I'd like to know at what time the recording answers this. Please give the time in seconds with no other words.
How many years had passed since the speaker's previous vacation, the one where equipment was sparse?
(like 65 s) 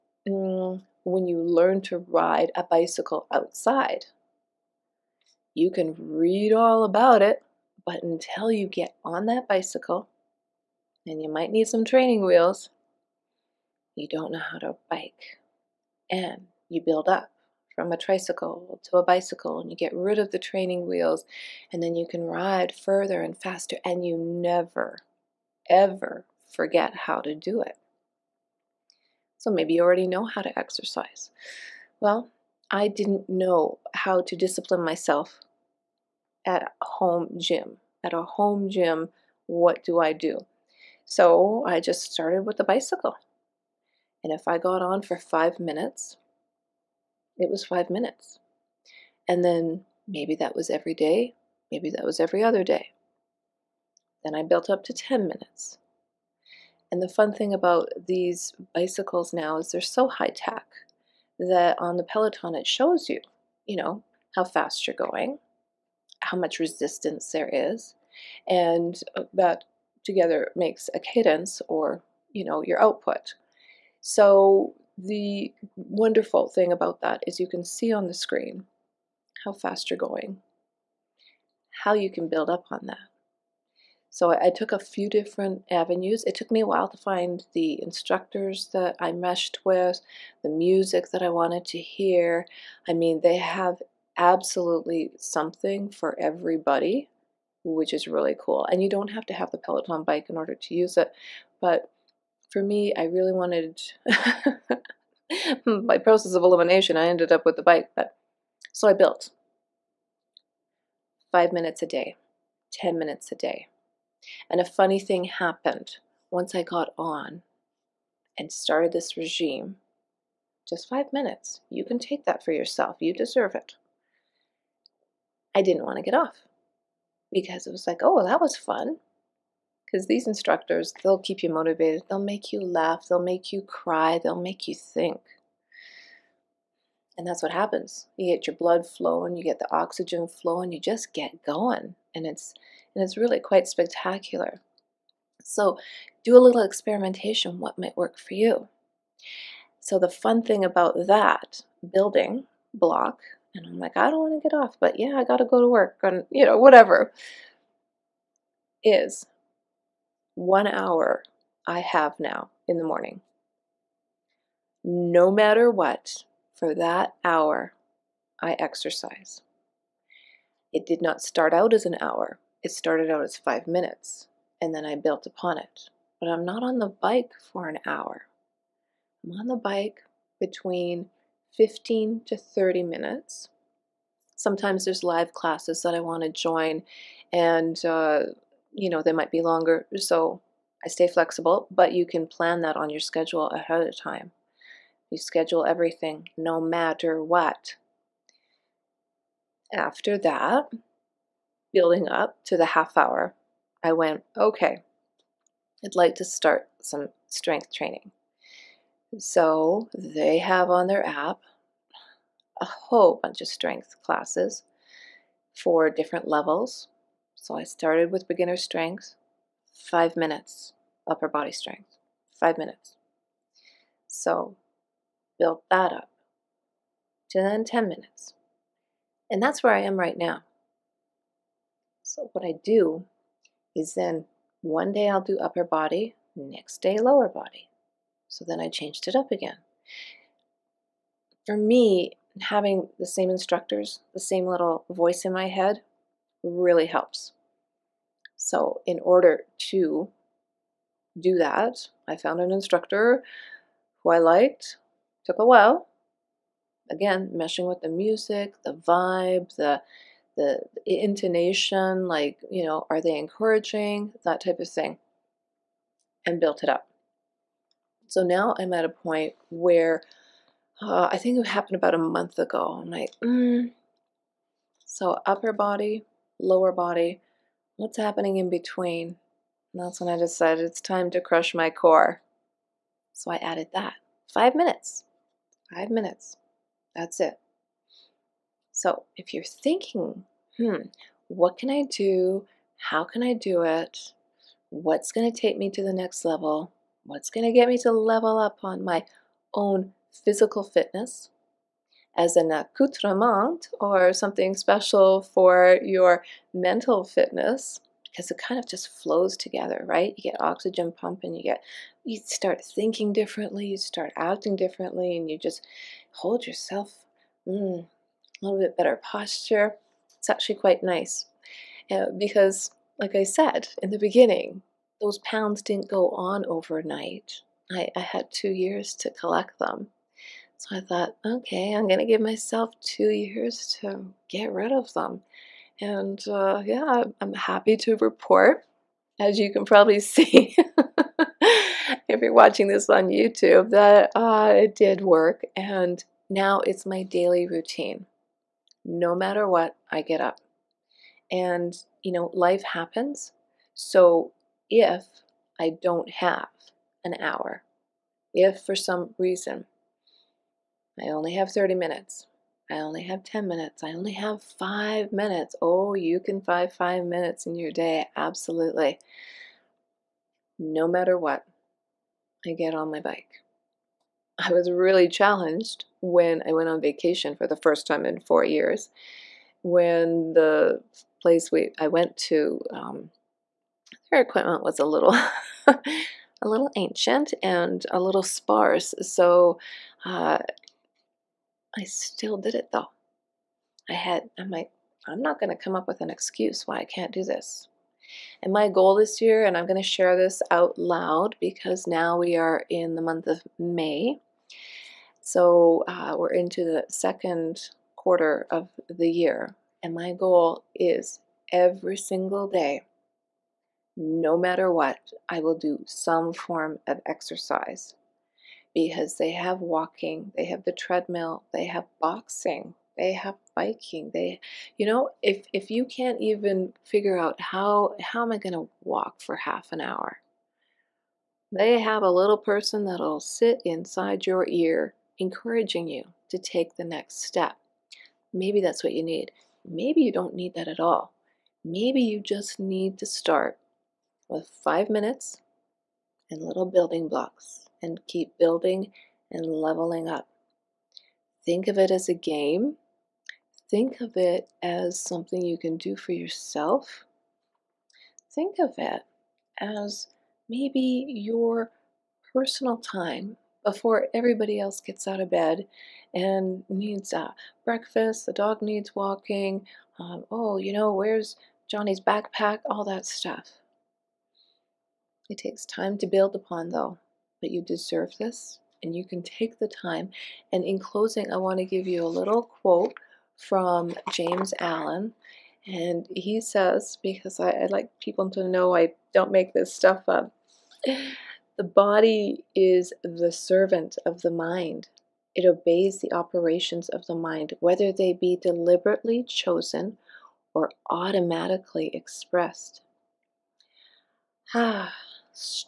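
378 s.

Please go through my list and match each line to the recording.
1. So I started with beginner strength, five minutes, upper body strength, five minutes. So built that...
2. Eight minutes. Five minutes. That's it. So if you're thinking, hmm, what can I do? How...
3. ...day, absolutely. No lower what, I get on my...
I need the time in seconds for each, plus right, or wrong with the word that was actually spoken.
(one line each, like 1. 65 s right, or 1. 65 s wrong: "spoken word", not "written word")
1. 217 s right
2. 284 s wrong: "Five", not "Eight"
3. 367 s wrong: "matter", not "lower".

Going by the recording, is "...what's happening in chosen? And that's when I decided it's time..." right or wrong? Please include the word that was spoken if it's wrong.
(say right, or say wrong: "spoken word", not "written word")
wrong: "between", not "chosen".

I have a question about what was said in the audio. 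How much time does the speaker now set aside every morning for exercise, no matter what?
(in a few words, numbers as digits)
1 hour.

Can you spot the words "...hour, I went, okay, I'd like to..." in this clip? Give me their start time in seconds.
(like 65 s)
202 s.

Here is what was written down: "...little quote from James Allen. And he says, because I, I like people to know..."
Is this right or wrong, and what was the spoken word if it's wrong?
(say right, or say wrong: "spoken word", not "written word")
right.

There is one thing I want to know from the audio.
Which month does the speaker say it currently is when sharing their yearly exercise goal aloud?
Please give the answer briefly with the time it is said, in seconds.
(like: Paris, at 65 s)
May, at 403 s.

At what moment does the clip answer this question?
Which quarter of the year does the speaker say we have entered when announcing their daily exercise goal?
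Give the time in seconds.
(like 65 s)
406 s.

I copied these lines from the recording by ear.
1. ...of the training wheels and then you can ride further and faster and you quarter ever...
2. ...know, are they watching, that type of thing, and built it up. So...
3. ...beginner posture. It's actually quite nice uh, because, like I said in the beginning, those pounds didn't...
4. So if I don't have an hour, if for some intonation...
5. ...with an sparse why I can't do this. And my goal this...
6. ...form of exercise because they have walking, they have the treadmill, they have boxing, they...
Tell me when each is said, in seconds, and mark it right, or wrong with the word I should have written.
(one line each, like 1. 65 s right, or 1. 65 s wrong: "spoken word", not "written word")
1. 20 s wrong: "never", not "quarter"
2. 262 s wrong: "encouraging", not "watching"
3. 318 s wrong: "better", not "beginner"
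4. 353 s wrong: "reason", not "intonation"
5. 395 s wrong: "excuse", not "sparse"
6. 416 s right.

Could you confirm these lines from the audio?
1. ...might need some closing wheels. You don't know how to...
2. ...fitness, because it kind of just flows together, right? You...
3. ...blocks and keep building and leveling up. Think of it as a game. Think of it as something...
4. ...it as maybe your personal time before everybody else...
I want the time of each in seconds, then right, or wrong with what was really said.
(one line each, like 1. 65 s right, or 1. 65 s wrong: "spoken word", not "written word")
1. 11 s wrong: "training", not "closing"
2. 307 s right
3. 447 s right
4. 458 s right.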